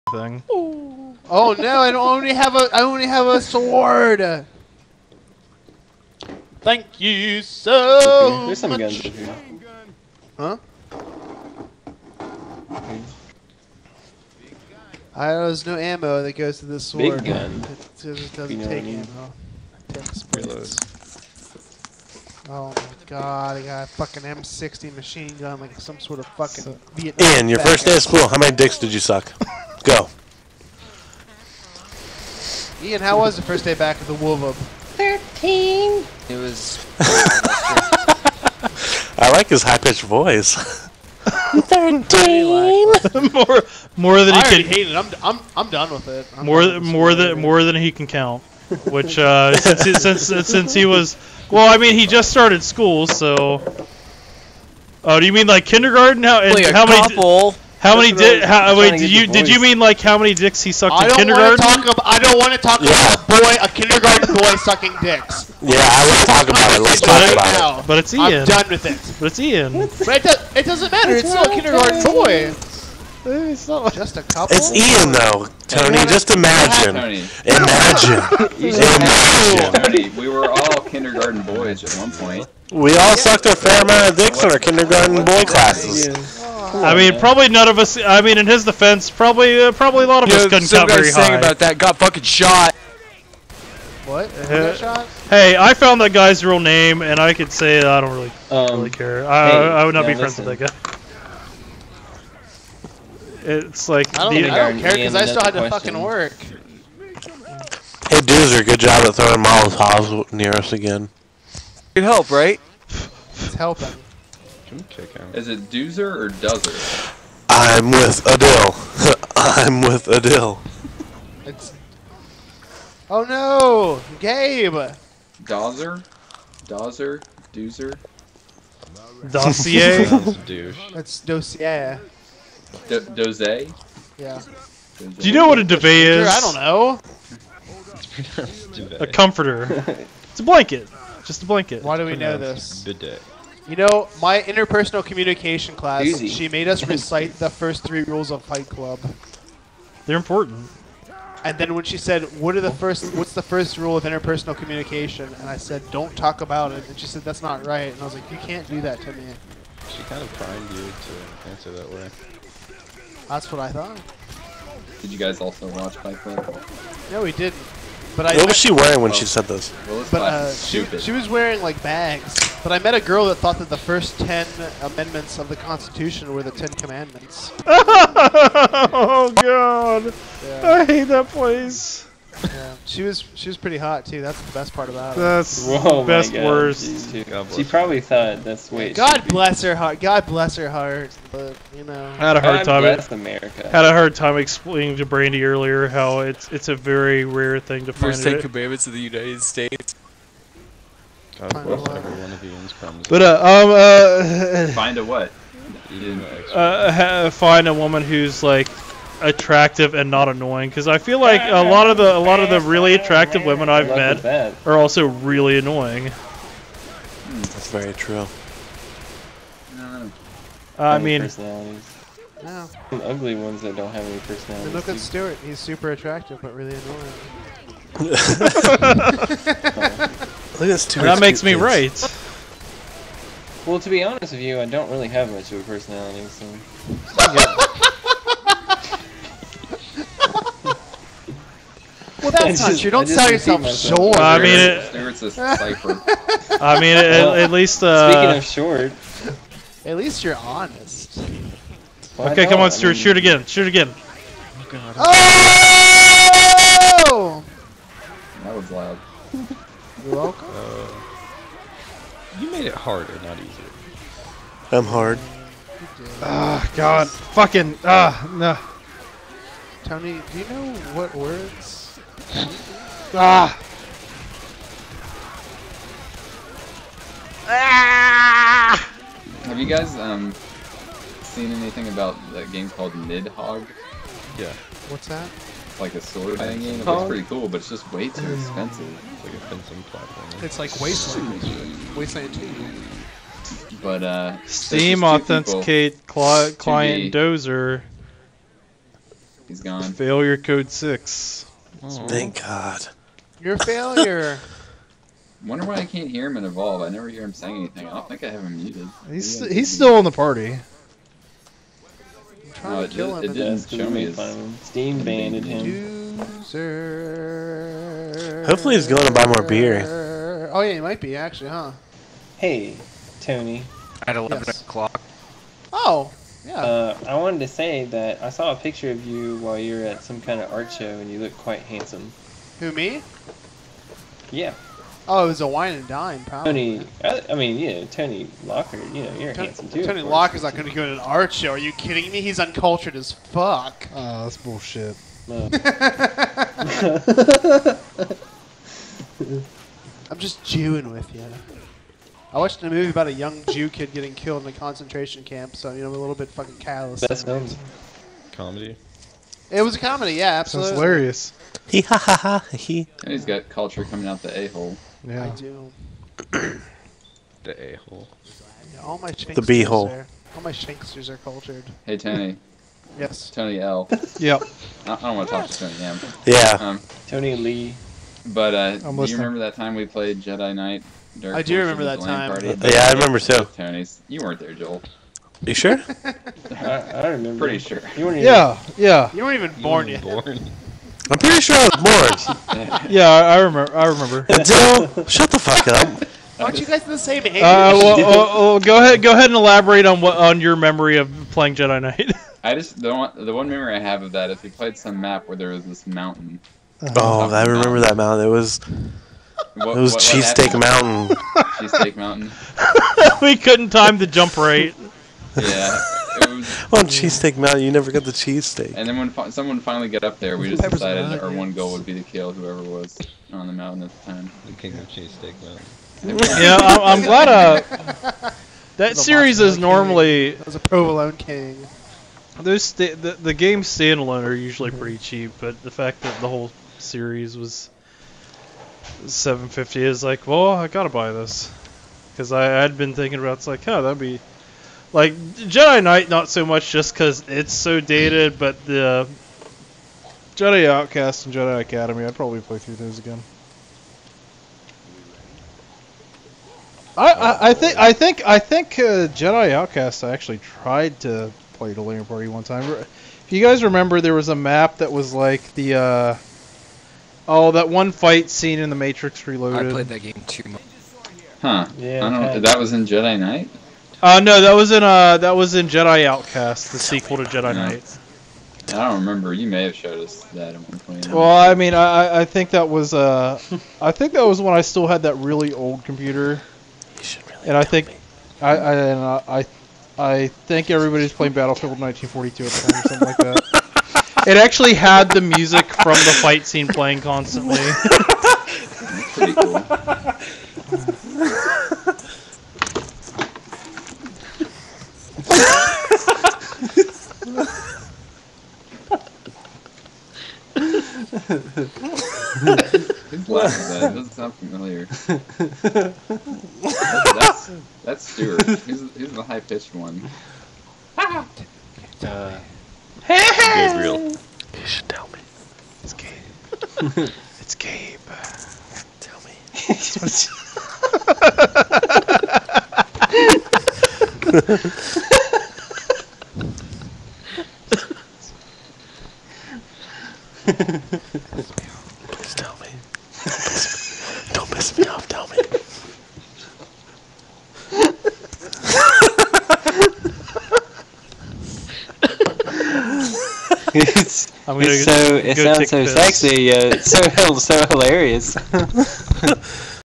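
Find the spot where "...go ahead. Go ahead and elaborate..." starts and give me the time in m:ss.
6:38.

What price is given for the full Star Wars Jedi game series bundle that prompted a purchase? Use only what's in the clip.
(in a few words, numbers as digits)
750.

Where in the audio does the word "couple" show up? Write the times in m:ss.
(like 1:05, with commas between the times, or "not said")
0:57, 1:14.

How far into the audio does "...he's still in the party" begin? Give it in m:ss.
5:09.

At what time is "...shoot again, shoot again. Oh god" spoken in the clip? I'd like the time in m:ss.
4:13.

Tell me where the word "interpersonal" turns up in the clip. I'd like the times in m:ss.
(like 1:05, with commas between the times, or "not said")
2:24, 2:34.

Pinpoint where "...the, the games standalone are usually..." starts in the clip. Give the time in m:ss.
7:12.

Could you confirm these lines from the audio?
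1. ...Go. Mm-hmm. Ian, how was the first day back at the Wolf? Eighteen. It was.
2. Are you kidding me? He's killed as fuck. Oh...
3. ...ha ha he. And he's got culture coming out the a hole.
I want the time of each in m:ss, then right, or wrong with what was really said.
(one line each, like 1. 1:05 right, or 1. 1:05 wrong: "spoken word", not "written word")
1. 0:29 wrong: "Thirteen", not "Eighteen"
2. 5:41 wrong: "uncultured", not "killed"
3. 6:01 right.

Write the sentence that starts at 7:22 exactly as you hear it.
Because I had been thinking about it's like, oh, that'd be.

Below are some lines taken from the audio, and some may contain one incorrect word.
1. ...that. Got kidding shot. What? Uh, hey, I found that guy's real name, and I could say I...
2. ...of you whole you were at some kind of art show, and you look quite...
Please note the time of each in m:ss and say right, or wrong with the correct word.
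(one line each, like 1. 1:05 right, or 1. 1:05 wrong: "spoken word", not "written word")
1. 1:31 wrong: "fucking", not "kidding"
2. 5:28 wrong: "while", not "whole".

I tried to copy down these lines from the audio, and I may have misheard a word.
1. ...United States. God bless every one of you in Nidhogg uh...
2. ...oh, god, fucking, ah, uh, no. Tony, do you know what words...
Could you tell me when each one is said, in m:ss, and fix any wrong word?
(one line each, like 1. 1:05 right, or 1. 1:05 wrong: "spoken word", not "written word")
1. 3:18 wrong: "But", not "Nidhogg"
2. 4:26 right.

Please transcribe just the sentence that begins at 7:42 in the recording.
If you guys remember, there was a map that was like the uh, Oh, that one fight scene in The Matrix Reloaded.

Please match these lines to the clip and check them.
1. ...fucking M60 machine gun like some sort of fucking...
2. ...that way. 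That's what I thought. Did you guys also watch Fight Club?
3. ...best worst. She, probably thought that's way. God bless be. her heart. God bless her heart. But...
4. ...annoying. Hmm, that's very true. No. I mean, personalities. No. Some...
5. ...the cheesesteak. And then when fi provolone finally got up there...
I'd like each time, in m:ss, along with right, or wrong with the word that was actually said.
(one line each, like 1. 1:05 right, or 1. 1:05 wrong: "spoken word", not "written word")
1. 0:23 right
2. 2:41 right
3. 3:06 right
4. 3:35 right
5. 6:58 wrong: "someone", not "provolone".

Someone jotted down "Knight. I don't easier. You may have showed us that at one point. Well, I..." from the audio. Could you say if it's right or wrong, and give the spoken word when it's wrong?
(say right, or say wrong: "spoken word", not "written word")
wrong: "remember", not "easier".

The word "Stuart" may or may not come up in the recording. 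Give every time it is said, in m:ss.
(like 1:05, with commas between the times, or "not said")
3:44, 3:50, 4:12.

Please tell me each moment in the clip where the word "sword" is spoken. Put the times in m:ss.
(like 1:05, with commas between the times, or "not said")
0:03, 0:16, 4:46.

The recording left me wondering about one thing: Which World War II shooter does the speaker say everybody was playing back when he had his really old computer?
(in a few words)
Battlefield 1942.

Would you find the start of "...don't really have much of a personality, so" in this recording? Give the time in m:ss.
3:54.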